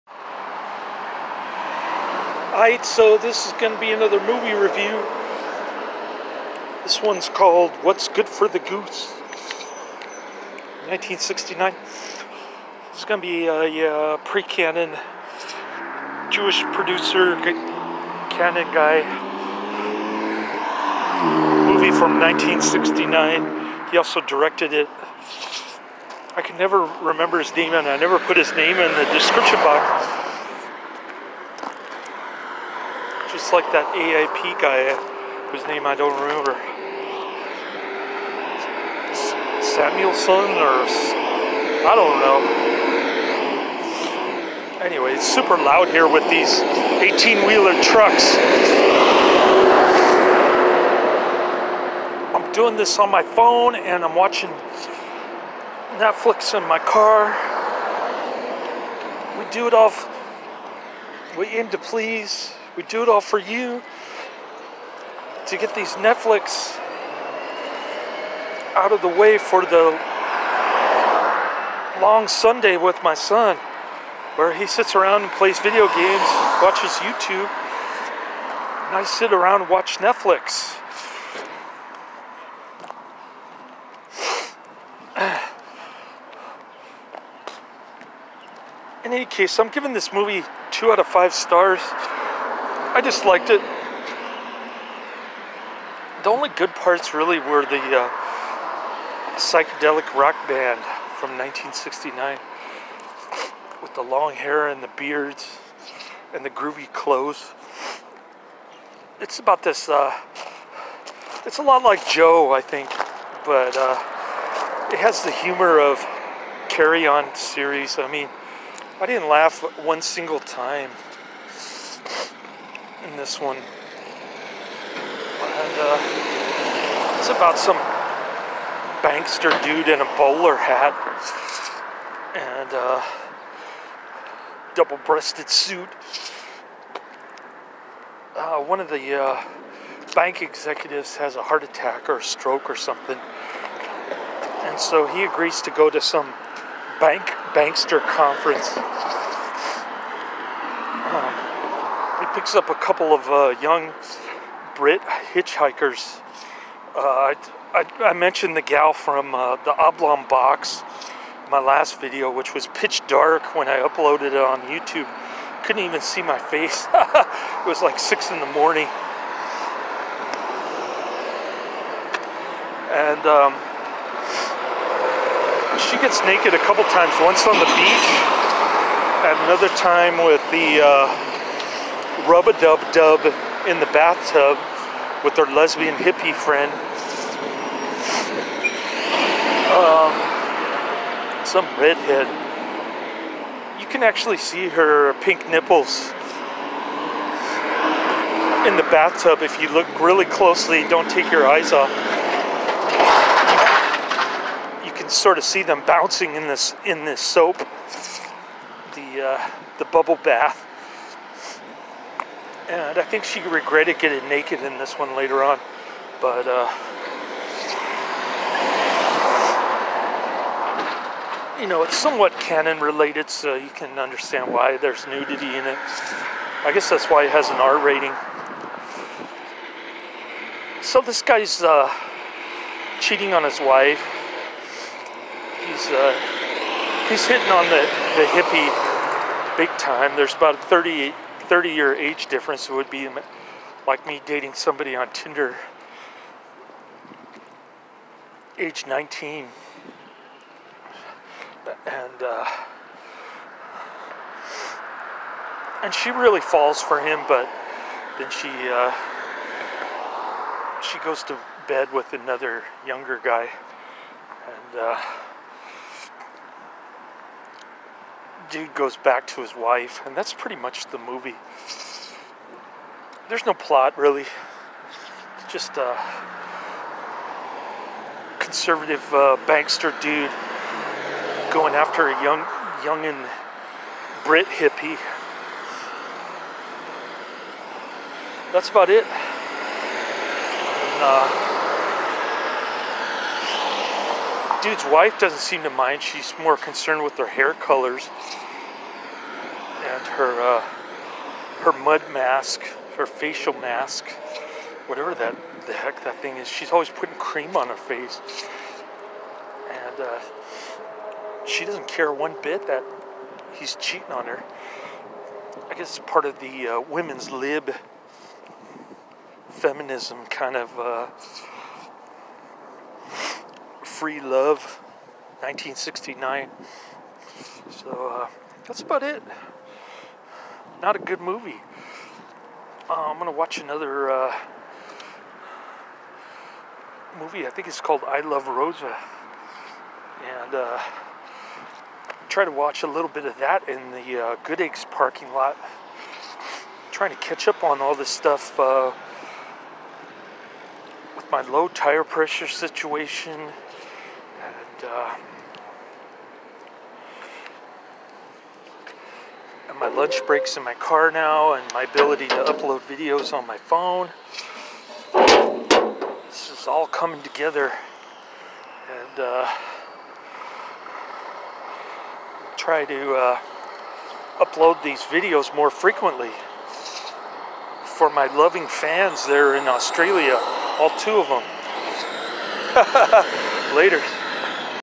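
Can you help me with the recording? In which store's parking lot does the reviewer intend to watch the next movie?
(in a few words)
Good Eggs.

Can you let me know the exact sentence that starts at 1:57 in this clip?
I mean, I didn't laugh one single time in this one.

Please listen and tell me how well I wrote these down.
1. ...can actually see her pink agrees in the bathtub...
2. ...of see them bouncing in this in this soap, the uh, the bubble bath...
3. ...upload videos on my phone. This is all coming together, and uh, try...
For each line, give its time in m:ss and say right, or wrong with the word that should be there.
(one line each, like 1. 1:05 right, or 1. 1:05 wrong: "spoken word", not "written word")
1. 3:13 wrong: "nipples", not "agrees"
2. 3:25 right
3. 6:02 right.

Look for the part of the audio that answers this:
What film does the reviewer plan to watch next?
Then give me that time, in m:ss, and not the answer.
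5:38.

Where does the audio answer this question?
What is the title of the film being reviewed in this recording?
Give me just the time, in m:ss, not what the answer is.
0:07.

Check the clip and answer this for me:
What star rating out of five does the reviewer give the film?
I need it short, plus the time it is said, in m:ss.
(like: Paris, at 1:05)
2, at 1:30.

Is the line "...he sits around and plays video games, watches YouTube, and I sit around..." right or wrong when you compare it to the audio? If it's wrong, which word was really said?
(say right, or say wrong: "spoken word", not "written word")
right.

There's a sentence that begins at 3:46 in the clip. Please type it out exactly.
I guess that's why it has an R rating.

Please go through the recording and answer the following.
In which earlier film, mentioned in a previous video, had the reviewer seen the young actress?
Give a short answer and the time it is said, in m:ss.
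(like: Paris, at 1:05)
The Oblong Box, at 2:39.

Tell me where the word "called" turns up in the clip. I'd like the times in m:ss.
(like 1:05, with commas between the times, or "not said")
0:07, 5:37.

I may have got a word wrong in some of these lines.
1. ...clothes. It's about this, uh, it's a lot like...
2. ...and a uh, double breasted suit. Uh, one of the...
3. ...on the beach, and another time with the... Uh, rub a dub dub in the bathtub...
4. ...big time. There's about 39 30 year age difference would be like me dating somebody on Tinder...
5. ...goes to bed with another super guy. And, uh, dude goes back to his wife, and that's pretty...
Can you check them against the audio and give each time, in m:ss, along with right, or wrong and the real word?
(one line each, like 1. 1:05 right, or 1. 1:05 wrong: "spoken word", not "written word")
1. 1:46 right
2. 2:12 right
3. 2:57 right
4. 3:59 wrong: "38", not "39"
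5. 4:20 wrong: "younger", not "super".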